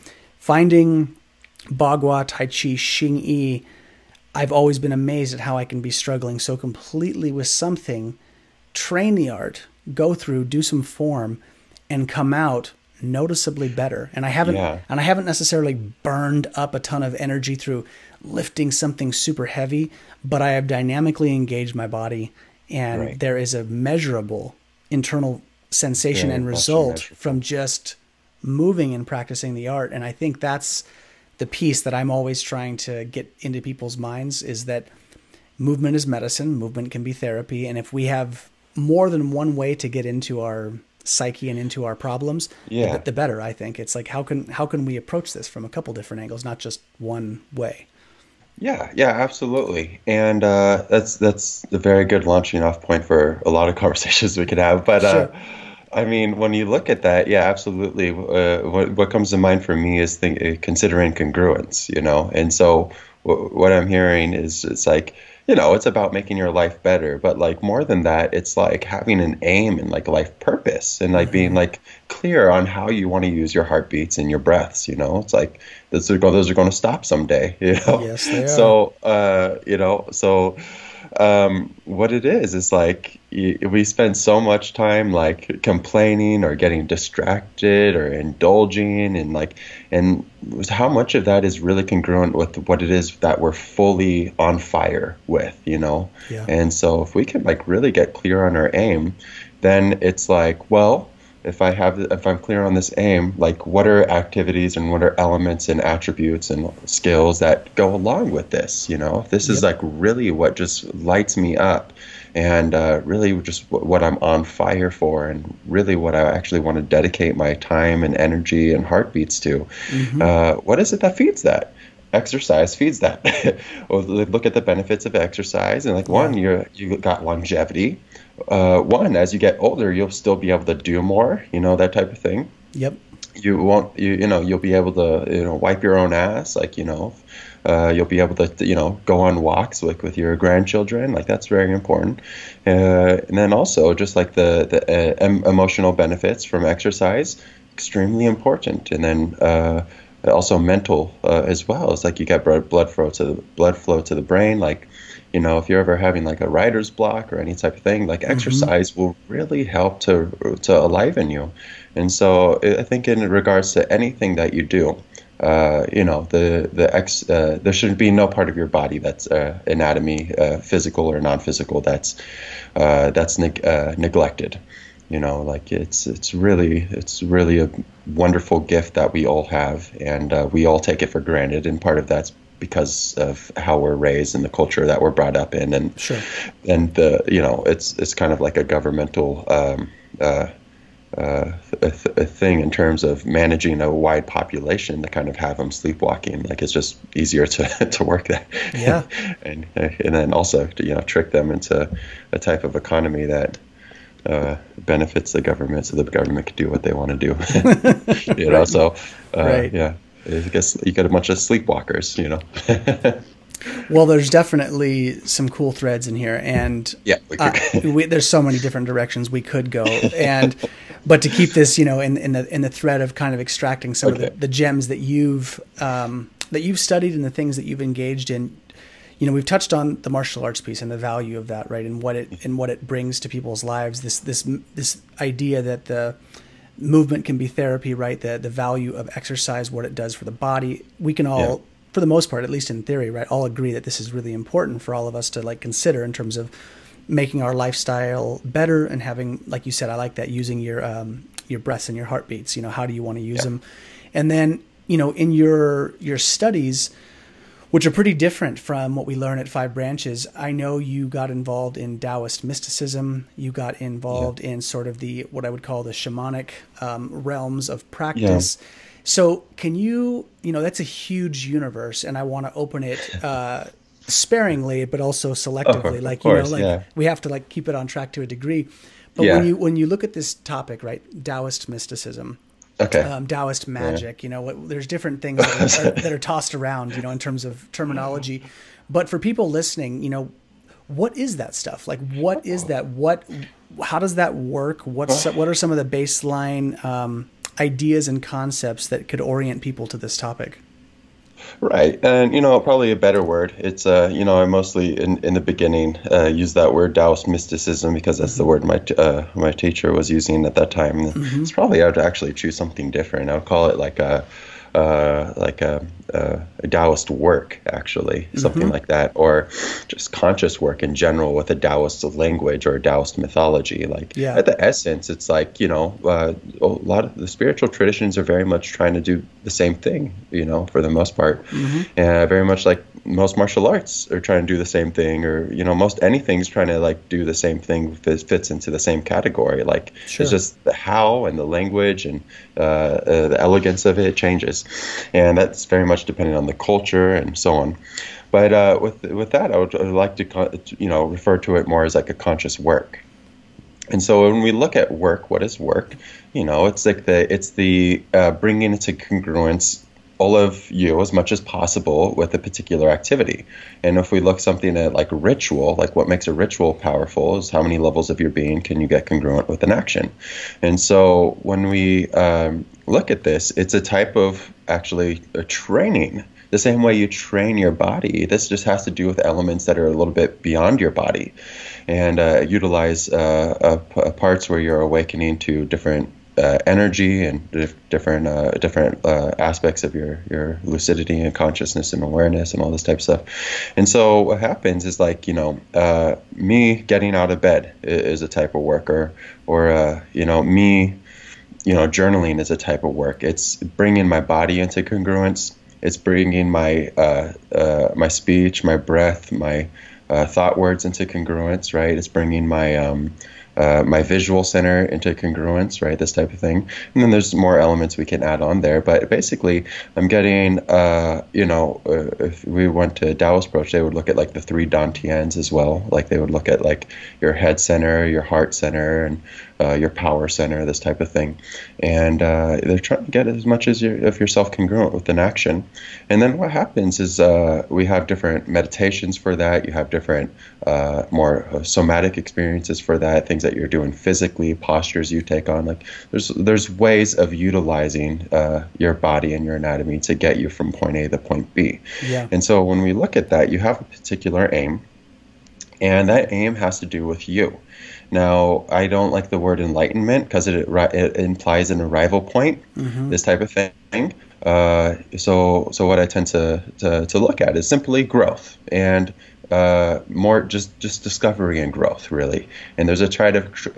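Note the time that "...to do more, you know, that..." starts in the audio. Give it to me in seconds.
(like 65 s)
130 s.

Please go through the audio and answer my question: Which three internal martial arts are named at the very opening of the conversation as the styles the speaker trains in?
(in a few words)
bagua, tai chi, xing yi.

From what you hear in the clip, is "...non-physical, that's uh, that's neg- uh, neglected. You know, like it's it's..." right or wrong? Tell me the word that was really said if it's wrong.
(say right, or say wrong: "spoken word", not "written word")
right.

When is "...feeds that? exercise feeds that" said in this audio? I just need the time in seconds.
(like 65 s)
121 s.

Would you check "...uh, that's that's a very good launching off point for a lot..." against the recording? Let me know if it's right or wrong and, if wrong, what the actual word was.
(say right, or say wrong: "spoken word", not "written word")
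right.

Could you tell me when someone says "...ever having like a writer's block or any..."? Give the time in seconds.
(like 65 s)
155 s.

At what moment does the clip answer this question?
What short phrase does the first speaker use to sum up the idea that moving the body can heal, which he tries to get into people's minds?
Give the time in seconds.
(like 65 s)
35 s.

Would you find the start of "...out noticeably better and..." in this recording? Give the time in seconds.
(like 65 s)
12 s.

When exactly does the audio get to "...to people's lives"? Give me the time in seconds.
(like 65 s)
233 s.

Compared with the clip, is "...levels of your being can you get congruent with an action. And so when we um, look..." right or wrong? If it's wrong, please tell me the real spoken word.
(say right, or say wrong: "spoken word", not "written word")
right.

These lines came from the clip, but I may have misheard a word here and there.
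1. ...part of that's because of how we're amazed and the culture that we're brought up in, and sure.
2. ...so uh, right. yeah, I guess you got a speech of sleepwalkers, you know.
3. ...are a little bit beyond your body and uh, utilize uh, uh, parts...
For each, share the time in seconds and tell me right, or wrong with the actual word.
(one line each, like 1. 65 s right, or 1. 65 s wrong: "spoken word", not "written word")
1. 181 s wrong: "raised", not "amazed"
2. 208 s wrong: "bunch", not "speech"
3. 379 s right.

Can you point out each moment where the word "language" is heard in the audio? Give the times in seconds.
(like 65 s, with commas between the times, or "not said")
322 s, 341 s.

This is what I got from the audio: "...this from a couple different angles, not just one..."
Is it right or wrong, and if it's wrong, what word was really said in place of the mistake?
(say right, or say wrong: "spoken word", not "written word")
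right.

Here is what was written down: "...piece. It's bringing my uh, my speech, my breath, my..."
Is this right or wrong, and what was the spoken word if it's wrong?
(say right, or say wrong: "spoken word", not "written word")
wrong: "congruence", not "piece".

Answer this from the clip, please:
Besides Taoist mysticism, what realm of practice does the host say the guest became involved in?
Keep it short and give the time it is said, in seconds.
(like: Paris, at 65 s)
shamanic, at 265 s.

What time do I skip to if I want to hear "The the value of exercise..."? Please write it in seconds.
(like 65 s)
238 s.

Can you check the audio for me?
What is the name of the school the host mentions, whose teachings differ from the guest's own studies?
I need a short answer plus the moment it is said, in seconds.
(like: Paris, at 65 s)
Five Branches, at 259 s.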